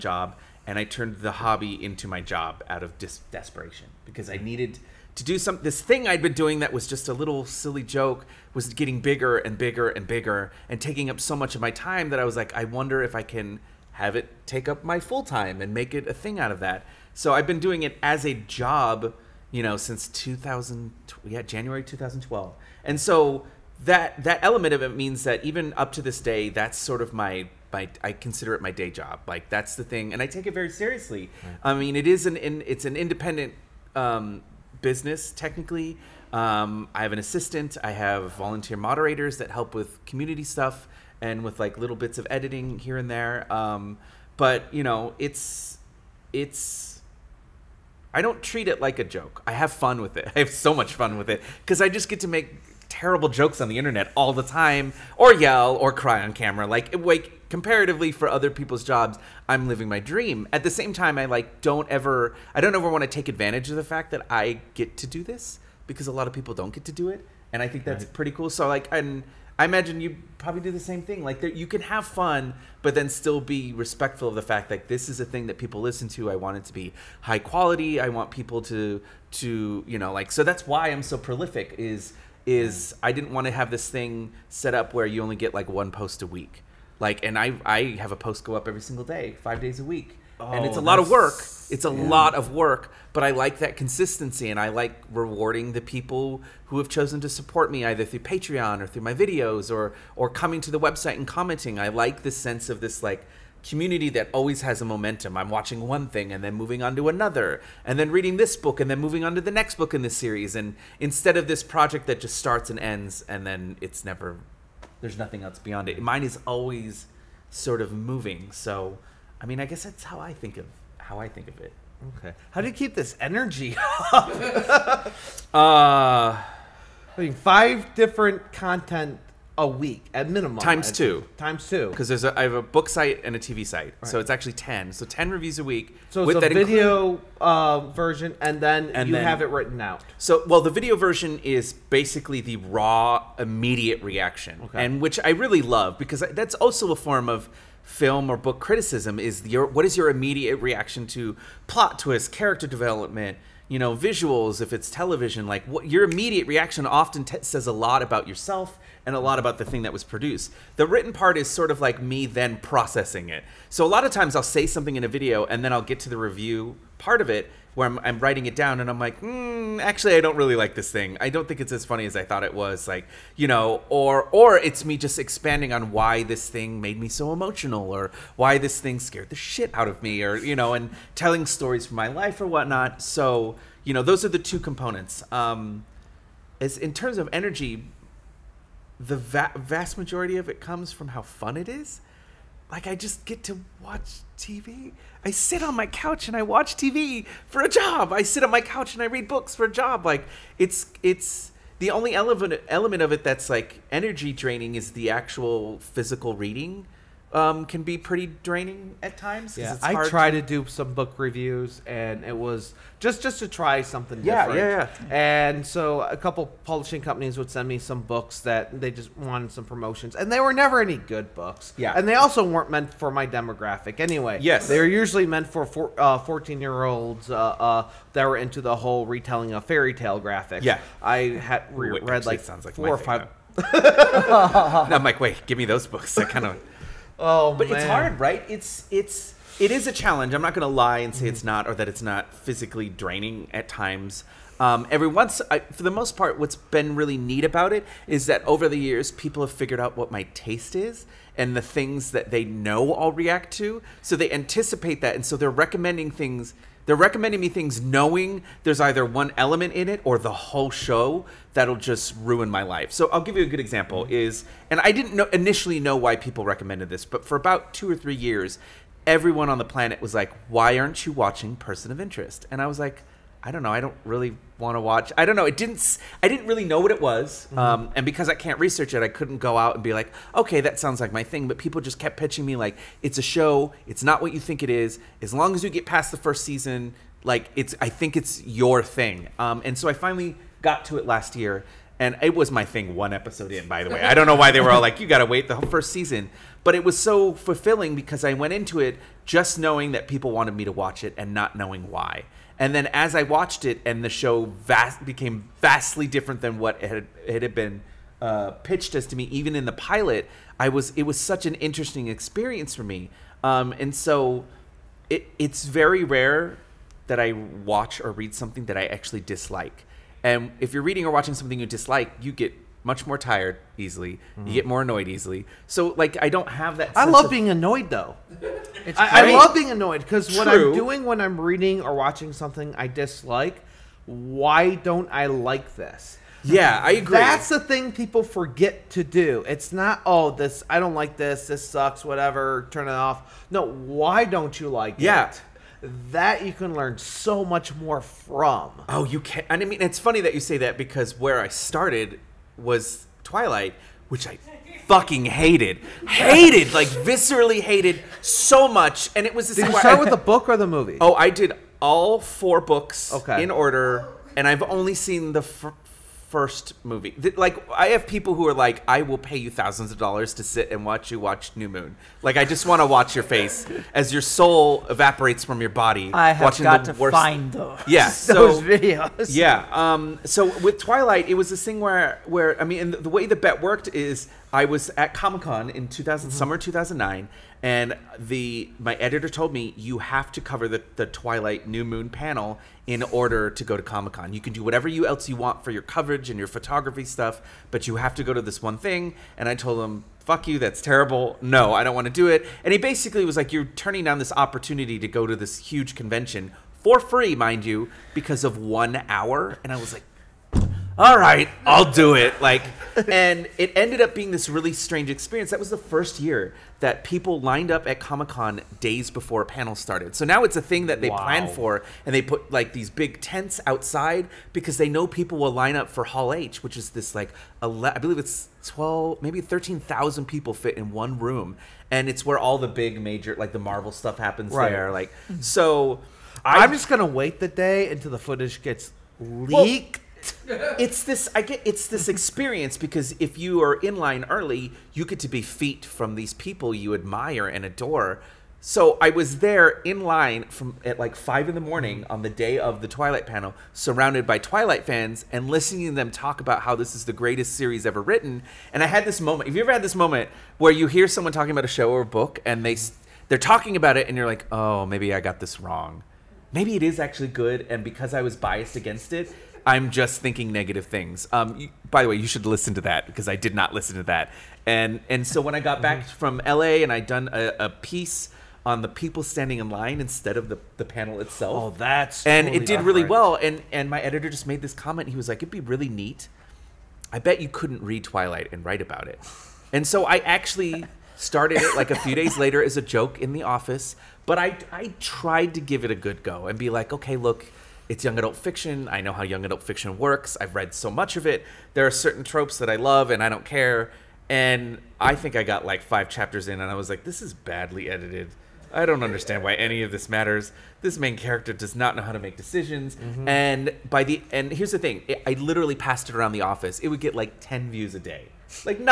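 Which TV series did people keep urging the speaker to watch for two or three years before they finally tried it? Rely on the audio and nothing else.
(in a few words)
Person of Interest.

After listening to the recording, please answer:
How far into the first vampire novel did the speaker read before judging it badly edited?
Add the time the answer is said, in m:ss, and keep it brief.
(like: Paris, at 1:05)
5, at 8:25.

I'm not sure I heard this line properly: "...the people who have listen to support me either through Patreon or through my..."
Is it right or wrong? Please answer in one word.
wrong.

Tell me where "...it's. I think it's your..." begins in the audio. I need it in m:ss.
4:47.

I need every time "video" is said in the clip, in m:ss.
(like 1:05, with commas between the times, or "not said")
1:39, 2:16, 2:20, 2:45, 6:18.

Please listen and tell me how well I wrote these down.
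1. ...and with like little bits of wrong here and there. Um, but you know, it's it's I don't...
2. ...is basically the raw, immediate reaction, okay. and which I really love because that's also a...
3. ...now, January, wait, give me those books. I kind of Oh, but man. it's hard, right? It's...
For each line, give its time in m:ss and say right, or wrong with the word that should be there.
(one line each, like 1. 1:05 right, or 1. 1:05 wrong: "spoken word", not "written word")
1. 0:41 wrong: "editing", not "wrong"
2. 2:21 right
3. 3:53 wrong: "Mike", not "January".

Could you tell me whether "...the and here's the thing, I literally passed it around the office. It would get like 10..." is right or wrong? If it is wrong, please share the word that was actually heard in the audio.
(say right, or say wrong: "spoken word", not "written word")
right.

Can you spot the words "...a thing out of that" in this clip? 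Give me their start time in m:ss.
0:16.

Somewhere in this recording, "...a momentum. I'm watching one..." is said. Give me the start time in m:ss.
1:44.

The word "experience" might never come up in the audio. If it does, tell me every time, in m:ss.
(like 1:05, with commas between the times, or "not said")
5:12, 6:55, 7:22.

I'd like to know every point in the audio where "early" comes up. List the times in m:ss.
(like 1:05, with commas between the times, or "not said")
7:24.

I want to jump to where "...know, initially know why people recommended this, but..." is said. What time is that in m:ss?
4:25.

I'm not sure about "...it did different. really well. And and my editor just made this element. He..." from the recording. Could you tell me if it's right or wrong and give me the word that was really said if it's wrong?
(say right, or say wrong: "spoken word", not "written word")
wrong: "comment", not "element".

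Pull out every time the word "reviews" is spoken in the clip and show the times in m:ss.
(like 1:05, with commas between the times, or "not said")
2:15, 2:46, 3:31.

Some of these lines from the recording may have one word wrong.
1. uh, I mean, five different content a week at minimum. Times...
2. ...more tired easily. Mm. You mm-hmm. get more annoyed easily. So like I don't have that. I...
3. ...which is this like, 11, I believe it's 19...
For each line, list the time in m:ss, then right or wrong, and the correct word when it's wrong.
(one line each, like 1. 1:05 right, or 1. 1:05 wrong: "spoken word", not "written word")
1. 2:05 right
2. 5:23 right
3. 7:06 wrong: "12", not "19".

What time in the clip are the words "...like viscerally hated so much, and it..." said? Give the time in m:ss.
5:56.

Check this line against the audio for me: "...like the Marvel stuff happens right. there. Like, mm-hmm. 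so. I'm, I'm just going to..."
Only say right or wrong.
right.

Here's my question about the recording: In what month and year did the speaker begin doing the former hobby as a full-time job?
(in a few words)
January 2012.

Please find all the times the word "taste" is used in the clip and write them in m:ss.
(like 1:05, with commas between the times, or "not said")
4:10.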